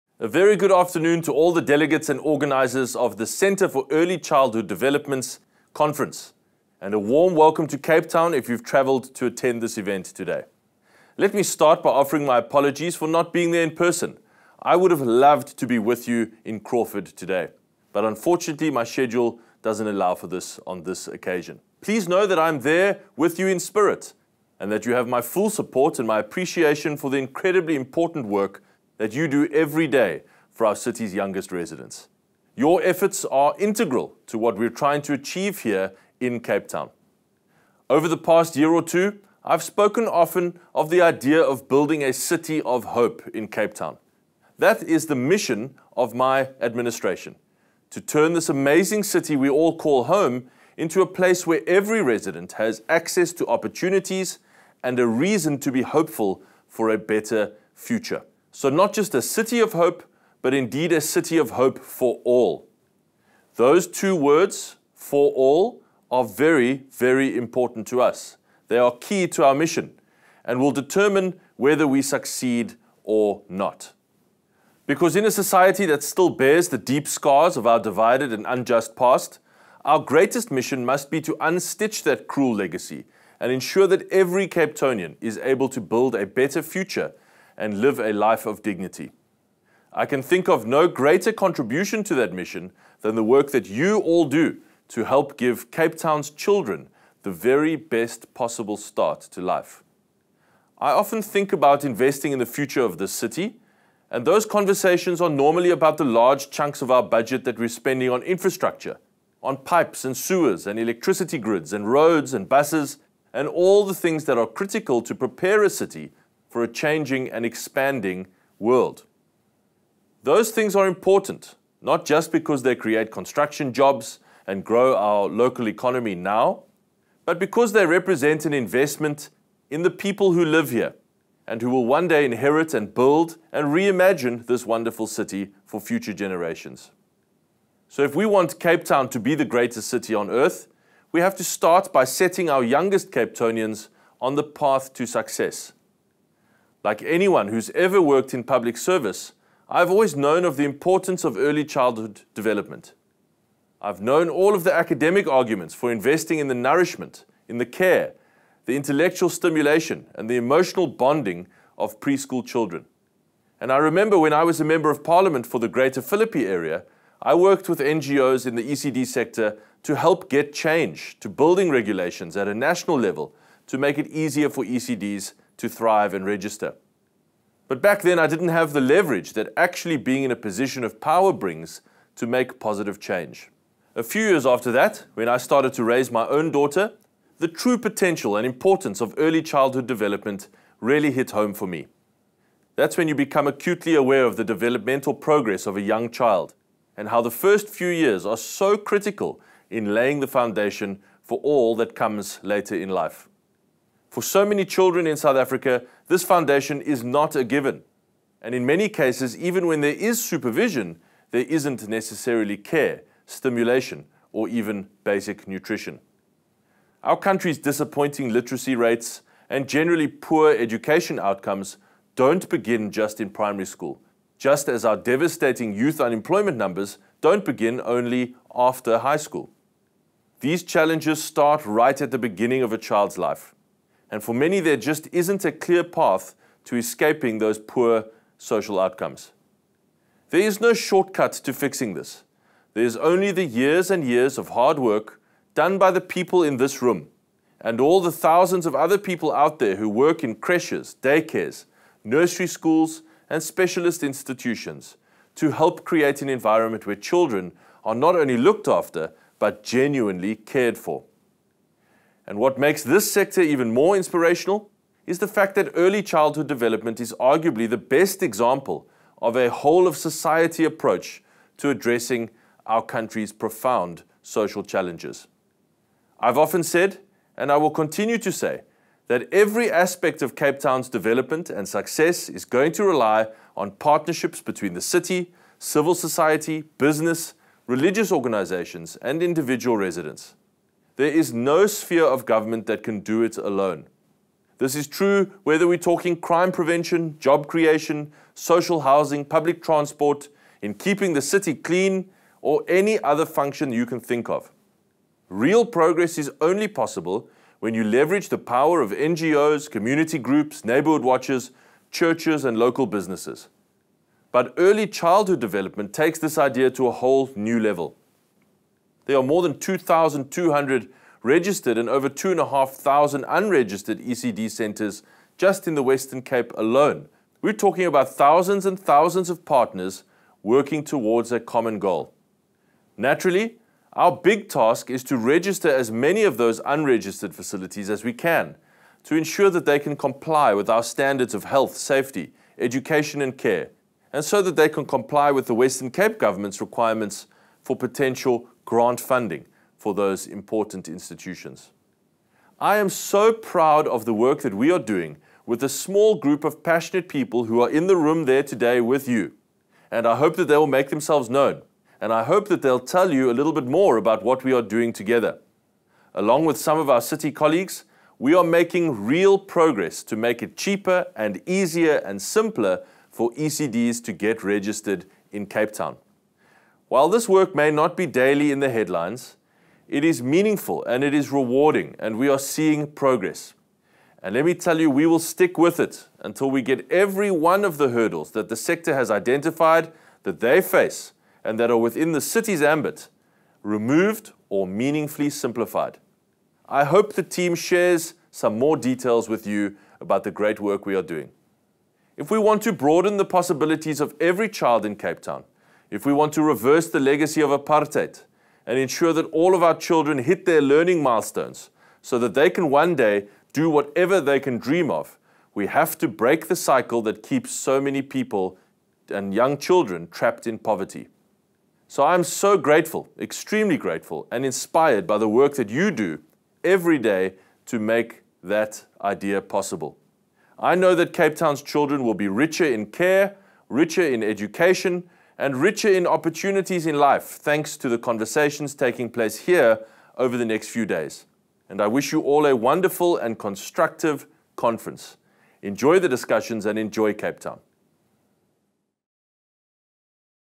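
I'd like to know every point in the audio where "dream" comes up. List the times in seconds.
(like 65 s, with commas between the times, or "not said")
414 s.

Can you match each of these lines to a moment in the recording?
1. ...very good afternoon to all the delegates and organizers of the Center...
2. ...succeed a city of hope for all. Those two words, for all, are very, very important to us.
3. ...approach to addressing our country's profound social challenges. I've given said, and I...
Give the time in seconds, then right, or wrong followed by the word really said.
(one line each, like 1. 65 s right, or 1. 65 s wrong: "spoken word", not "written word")
1. 0 s right
2. 60 s wrong: "indeed", not "succeed"
3. 270 s wrong: "often", not "given".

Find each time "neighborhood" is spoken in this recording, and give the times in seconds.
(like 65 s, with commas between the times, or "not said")
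310 s.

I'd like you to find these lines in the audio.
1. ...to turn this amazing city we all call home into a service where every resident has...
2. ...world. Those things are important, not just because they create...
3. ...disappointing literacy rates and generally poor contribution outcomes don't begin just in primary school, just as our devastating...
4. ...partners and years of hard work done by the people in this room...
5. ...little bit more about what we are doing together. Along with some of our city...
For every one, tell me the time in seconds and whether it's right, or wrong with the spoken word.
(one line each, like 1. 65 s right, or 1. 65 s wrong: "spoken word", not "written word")
1. 47 s wrong: "place", not "service"
2. 118 s right
3. 217 s wrong: "education", not "contribution"
4. 243 s wrong: "years", not "partners"
5. 363 s right.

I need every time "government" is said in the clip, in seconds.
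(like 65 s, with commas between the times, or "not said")
292 s, 346 s.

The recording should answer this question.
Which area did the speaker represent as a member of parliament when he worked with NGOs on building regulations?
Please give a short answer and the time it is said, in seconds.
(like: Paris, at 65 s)
Greater Philippi, at 165 s.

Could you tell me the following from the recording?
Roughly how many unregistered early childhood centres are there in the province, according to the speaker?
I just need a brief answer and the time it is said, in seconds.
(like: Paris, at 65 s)
over 2,500, at 321 s.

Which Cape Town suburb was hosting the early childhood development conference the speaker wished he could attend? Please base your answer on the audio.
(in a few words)
Crawford.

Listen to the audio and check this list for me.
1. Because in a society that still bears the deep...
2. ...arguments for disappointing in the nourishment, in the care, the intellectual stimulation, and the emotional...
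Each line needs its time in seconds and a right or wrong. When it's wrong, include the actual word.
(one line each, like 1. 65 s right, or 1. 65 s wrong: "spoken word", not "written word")
1. 74 s right
2. 155 s wrong: "investing", not "disappointing".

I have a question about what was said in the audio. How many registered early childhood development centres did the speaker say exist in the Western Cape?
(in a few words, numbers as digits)
more than 2,200.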